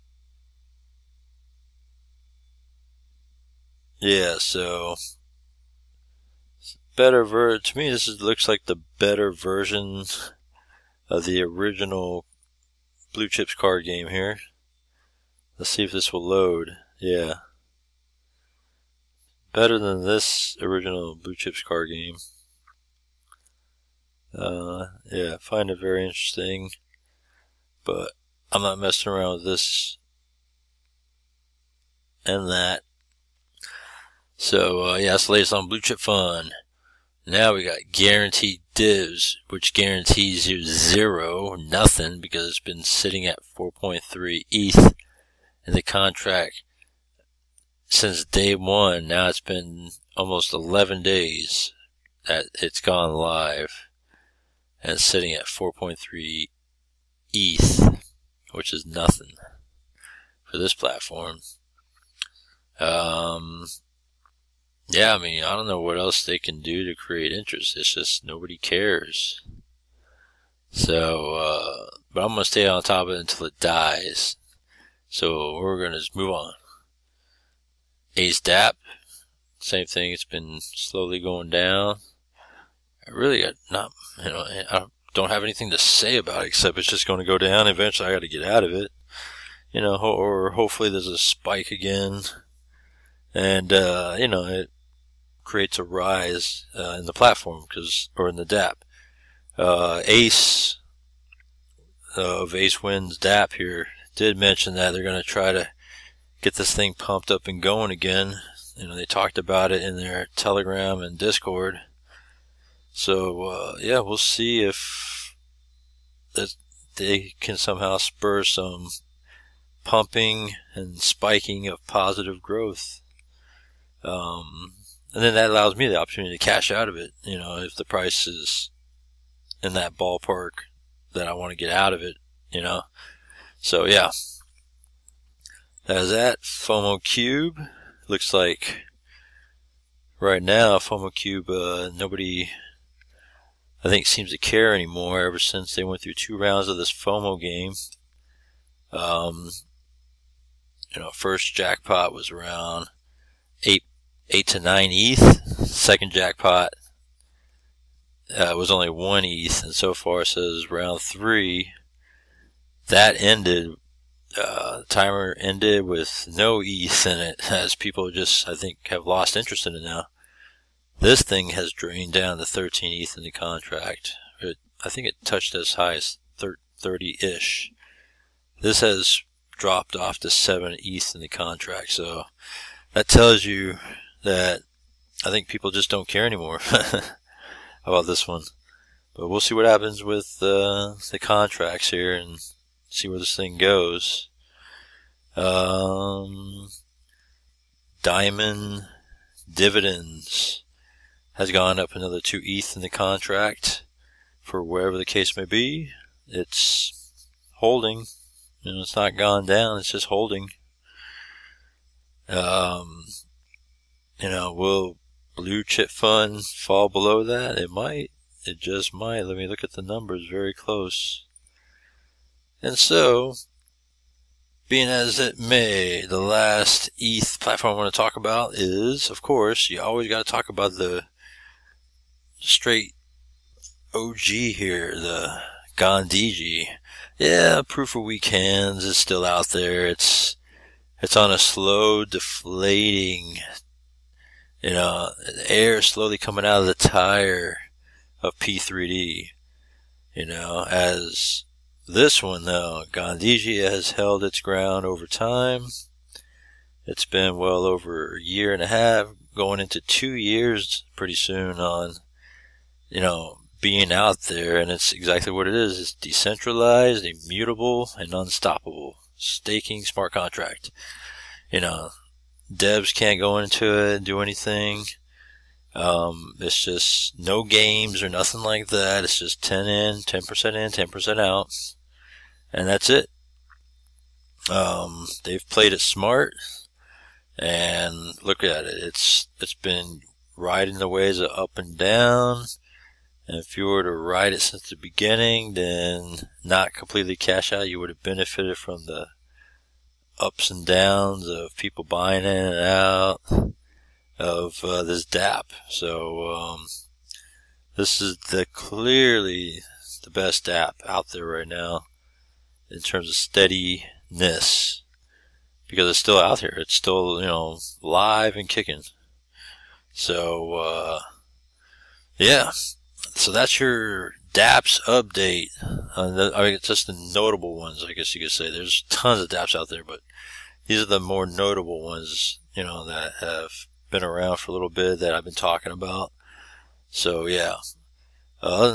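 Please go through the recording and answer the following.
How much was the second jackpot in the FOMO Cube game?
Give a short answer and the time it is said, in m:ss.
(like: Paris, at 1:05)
1 ETH, at 2:38.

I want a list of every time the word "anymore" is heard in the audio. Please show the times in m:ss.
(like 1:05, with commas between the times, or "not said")
2:24, 3:06.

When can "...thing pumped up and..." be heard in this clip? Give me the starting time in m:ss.
1:46.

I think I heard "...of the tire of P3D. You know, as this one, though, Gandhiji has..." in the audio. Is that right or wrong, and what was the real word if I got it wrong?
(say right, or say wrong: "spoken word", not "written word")
right.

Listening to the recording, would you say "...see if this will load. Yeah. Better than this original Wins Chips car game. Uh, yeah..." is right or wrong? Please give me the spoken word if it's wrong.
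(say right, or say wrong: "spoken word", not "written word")
wrong: "Blue", not "Wins".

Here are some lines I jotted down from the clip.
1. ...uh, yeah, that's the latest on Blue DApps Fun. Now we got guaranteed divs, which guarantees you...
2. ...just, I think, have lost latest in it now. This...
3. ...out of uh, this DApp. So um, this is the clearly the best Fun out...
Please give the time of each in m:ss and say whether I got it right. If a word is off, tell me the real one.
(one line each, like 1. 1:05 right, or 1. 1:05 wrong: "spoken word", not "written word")
1. 0:34 wrong: "Chip", not "DApps"
2. 2:48 wrong: "interest", not "latest"
3. 5:02 wrong: "DApp", not "Fun".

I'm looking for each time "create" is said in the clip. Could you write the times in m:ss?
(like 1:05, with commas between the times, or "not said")
1:06, 1:35.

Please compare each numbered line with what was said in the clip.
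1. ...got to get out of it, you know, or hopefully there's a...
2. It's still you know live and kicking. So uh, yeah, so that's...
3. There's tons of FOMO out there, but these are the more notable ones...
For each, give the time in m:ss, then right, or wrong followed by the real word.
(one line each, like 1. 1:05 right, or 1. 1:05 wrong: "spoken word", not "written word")
1. 1:28 right
2. 5:16 right
3. 5:28 wrong: "DApps", not "FOMO".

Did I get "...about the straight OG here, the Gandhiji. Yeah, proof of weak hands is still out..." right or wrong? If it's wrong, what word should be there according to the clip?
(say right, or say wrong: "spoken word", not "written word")
right.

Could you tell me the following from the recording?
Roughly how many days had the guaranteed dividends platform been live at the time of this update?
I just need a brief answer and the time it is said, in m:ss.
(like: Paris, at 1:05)
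11, at 0:50.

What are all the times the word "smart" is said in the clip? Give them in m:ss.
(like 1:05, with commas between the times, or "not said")
4:29, 4:45.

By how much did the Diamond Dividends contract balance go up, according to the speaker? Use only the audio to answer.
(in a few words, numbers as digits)
2 ETH.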